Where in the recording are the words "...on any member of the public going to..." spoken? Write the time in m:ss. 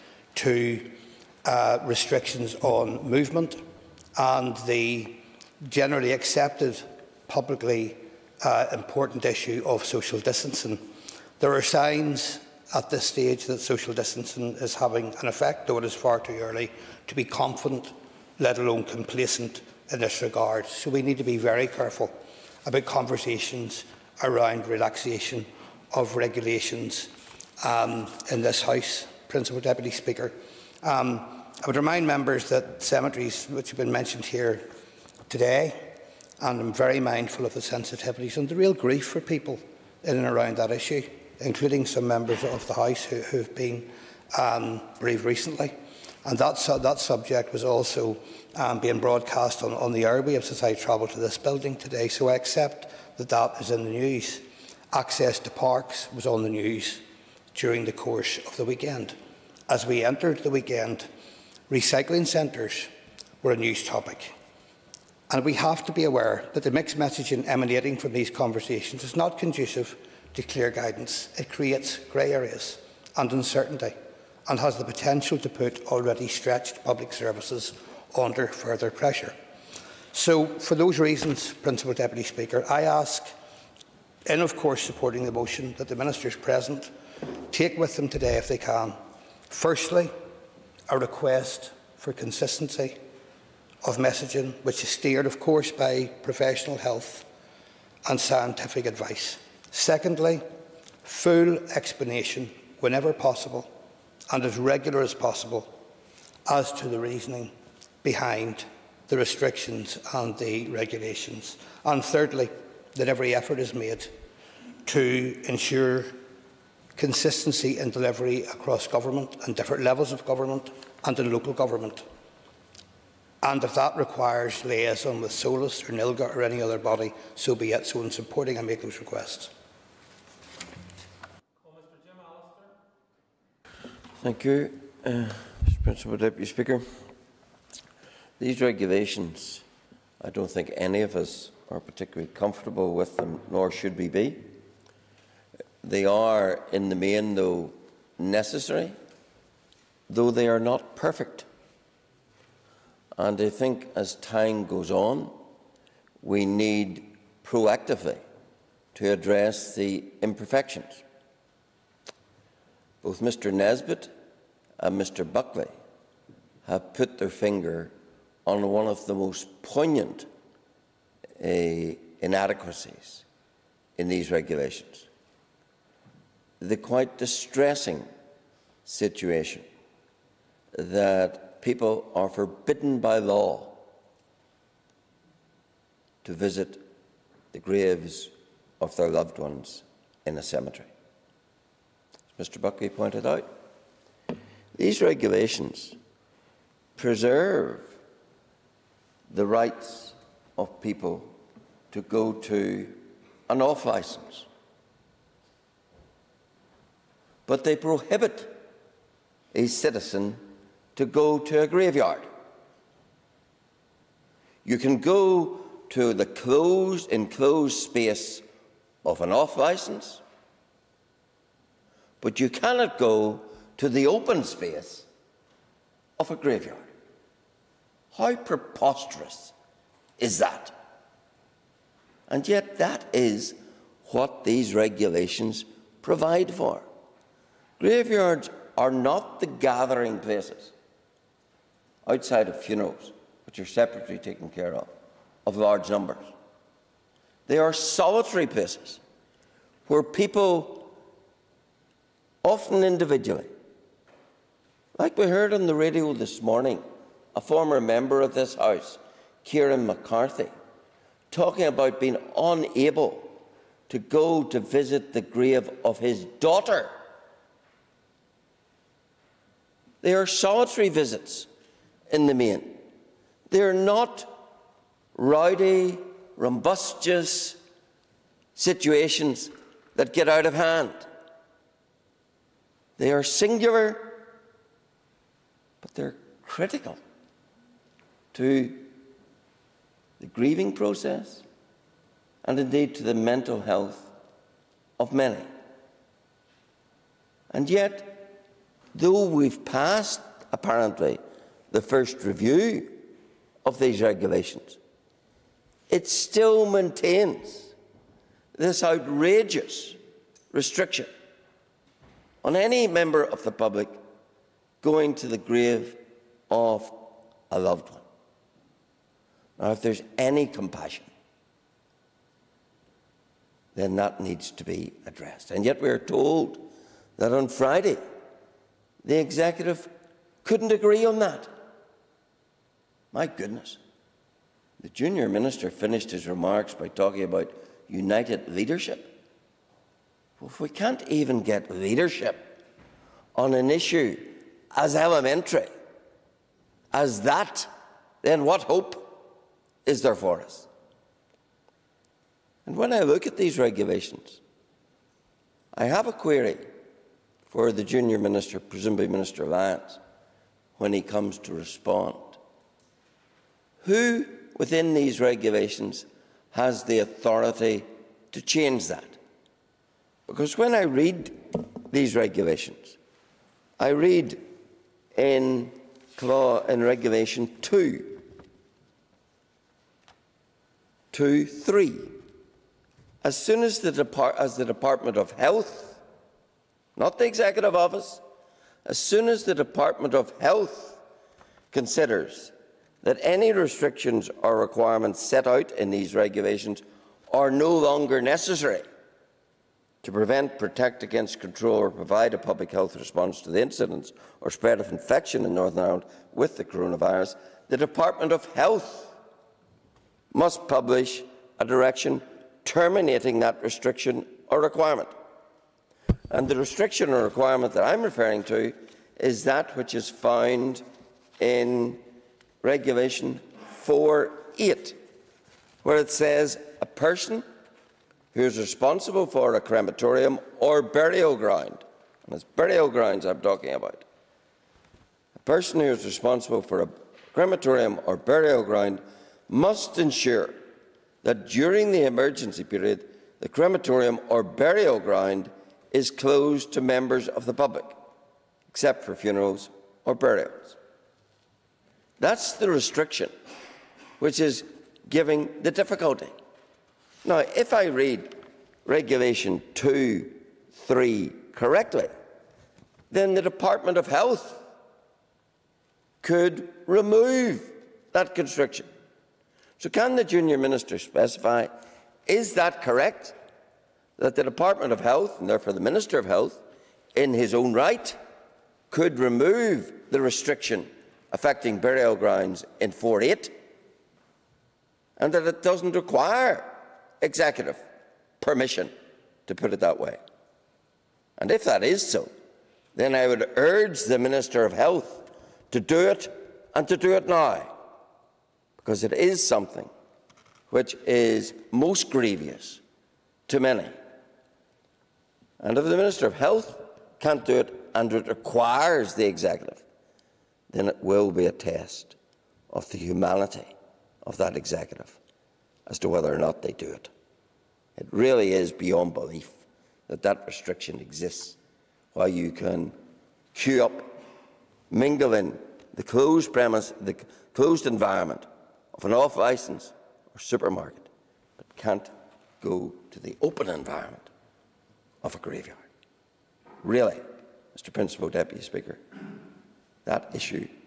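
5:12.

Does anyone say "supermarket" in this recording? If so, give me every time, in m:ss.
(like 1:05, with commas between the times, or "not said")
8:50.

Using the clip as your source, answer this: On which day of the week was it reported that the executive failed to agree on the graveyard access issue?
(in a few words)
Friday.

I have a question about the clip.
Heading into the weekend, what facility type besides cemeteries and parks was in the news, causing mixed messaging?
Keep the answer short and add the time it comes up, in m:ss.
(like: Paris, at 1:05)
Recycling centres, at 1:01.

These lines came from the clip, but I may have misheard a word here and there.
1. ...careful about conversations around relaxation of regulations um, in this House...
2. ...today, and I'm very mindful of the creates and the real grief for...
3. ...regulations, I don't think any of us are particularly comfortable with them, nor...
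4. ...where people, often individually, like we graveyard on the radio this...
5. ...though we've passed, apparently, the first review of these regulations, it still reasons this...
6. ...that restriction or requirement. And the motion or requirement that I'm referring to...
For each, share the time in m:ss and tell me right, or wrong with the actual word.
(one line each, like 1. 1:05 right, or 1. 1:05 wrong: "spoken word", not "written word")
1. 0:21 right
2. 0:35 wrong: "sensitivities", not "creates"
3. 2:18 right
4. 4:09 wrong: "heard", not "graveyard"
5. 4:58 wrong: "maintains", not "reasons"
6. 6:53 wrong: "restriction", not "motion".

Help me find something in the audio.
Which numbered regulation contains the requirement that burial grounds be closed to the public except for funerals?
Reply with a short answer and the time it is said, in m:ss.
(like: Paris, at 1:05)
Regulation 4.8, at 7:02.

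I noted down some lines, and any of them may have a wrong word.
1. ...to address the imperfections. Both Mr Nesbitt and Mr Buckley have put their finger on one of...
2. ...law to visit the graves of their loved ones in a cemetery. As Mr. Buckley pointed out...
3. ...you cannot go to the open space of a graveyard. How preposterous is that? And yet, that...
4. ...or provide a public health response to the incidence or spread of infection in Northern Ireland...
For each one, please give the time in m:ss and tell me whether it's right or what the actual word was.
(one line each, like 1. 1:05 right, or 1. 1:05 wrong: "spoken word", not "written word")
1. 2:38 right
2. 3:03 right
3. 3:42 right
4. 6:41 right.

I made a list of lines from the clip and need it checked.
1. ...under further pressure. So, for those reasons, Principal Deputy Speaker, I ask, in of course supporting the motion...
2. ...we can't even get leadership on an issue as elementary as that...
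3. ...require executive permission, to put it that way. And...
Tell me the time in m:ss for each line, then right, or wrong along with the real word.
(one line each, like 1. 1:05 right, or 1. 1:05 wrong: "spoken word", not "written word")
1. 1:18 right
2. 5:40 right
3. 8:05 right.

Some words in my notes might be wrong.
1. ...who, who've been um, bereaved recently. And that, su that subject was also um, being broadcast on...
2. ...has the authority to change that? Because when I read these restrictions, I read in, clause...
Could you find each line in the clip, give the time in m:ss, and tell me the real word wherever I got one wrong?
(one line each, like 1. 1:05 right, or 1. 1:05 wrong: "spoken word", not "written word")
1. 0:43 right
2. 6:06 wrong: "regulations", not "restrictions".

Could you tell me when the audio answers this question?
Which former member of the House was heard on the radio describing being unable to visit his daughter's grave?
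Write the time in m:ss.
4:19.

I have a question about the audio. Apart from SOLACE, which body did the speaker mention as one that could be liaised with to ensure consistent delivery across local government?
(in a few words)
NILGA.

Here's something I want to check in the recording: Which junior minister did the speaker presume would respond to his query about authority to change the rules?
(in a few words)
Minister Lyons.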